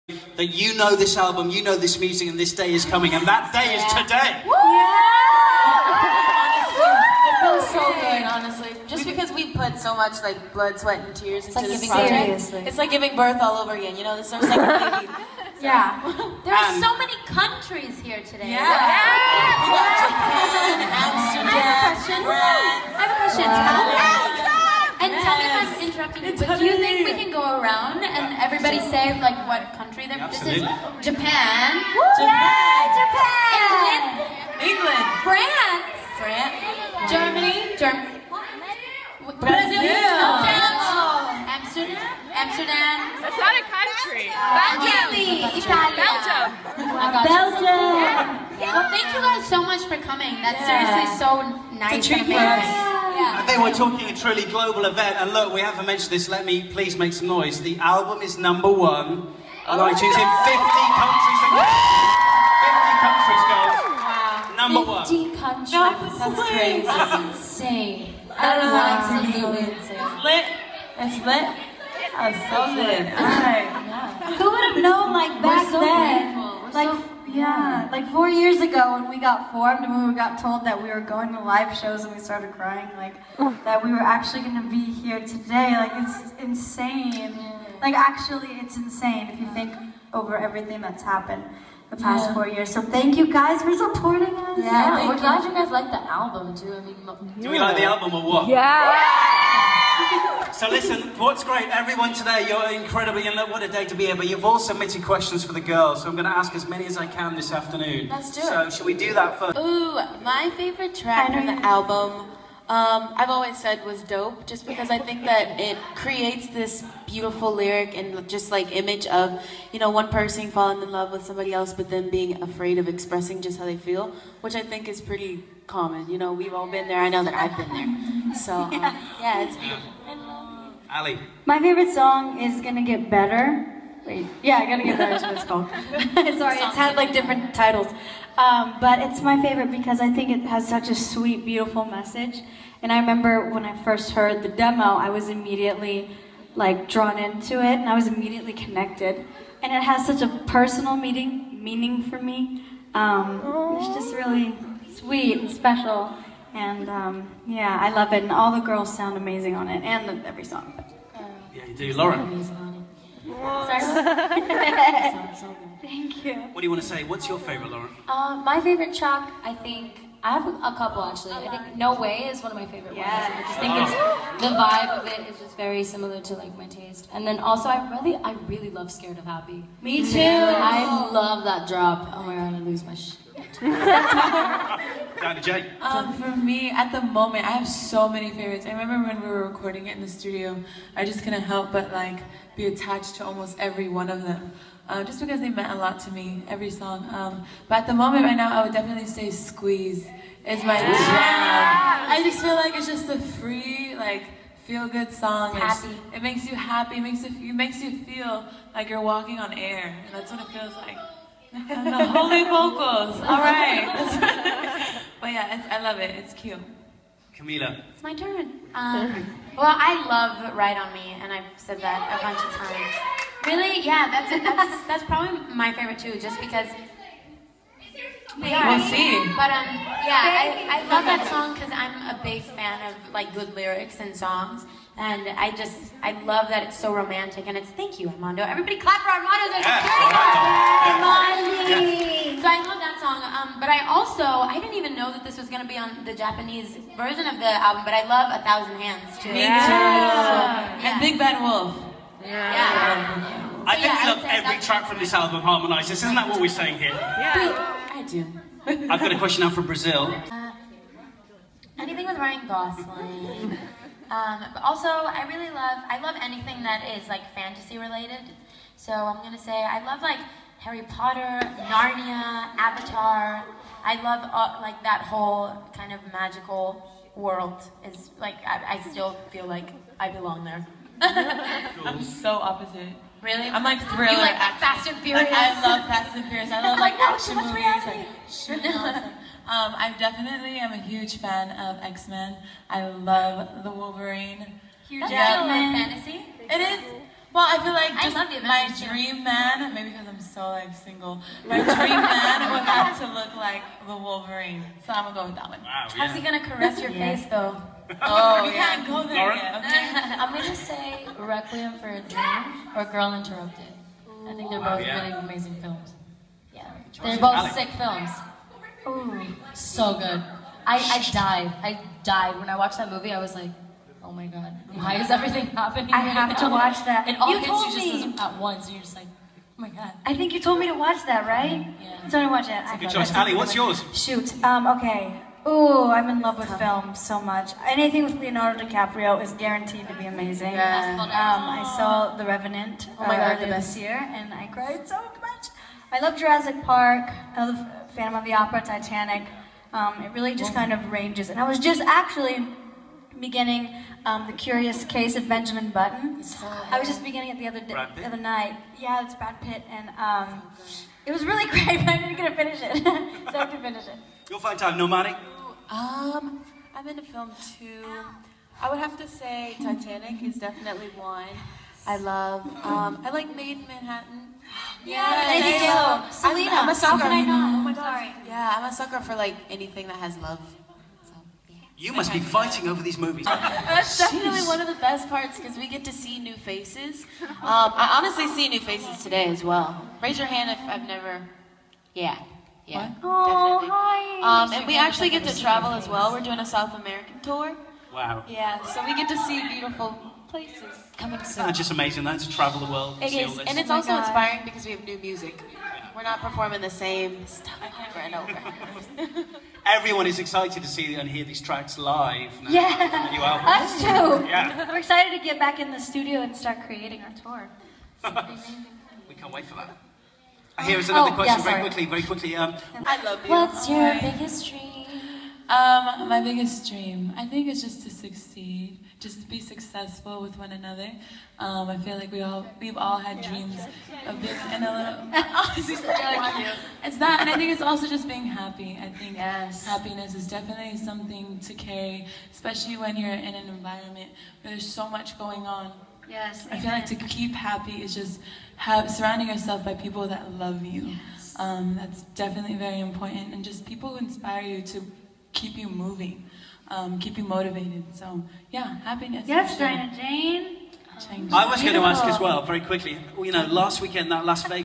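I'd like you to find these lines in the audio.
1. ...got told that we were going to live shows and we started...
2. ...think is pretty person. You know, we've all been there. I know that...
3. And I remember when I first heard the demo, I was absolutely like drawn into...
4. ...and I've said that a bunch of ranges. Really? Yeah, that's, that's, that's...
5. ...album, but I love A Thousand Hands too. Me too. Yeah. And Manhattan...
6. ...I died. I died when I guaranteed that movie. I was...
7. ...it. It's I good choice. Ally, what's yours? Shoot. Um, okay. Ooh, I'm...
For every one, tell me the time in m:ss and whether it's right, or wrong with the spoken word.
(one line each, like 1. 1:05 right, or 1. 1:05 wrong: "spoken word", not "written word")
1. 1:20 right
2. 2:04 wrong: "common", not "person"
3. 2:22 wrong: "immediately", not "absolutely"
4. 3:41 wrong: "times", not "ranges"
5. 4:07 wrong: "Big", not "Manhattan"
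6. 5:20 wrong: "watched", not "guaranteed"
7. 5:32 right.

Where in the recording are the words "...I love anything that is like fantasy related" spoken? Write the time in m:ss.
4:25.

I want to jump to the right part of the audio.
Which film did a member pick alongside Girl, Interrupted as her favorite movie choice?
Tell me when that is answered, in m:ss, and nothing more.
5:11.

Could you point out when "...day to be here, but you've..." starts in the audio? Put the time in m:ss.
1:43.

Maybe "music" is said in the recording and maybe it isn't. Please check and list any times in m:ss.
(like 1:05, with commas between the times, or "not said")
0:01, 6:44.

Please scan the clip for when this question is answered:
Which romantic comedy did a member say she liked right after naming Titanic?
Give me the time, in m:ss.
6:13.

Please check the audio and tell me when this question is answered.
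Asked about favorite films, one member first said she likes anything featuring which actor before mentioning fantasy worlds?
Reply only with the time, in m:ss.
4:22.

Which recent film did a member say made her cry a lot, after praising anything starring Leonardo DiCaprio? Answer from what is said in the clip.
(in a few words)
The Revenant.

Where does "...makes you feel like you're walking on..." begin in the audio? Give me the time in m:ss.
3:27.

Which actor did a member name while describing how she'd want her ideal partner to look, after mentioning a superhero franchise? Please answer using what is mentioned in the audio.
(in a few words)
Hugh Jackman.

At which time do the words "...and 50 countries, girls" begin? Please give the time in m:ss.
1:04.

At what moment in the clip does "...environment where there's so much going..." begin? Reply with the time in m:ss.
7:23.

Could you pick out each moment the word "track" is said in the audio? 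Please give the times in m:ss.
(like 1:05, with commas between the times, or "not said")
1:50, 2:48, 4:14, 6:51.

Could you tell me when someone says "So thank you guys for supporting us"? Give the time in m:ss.
1:32.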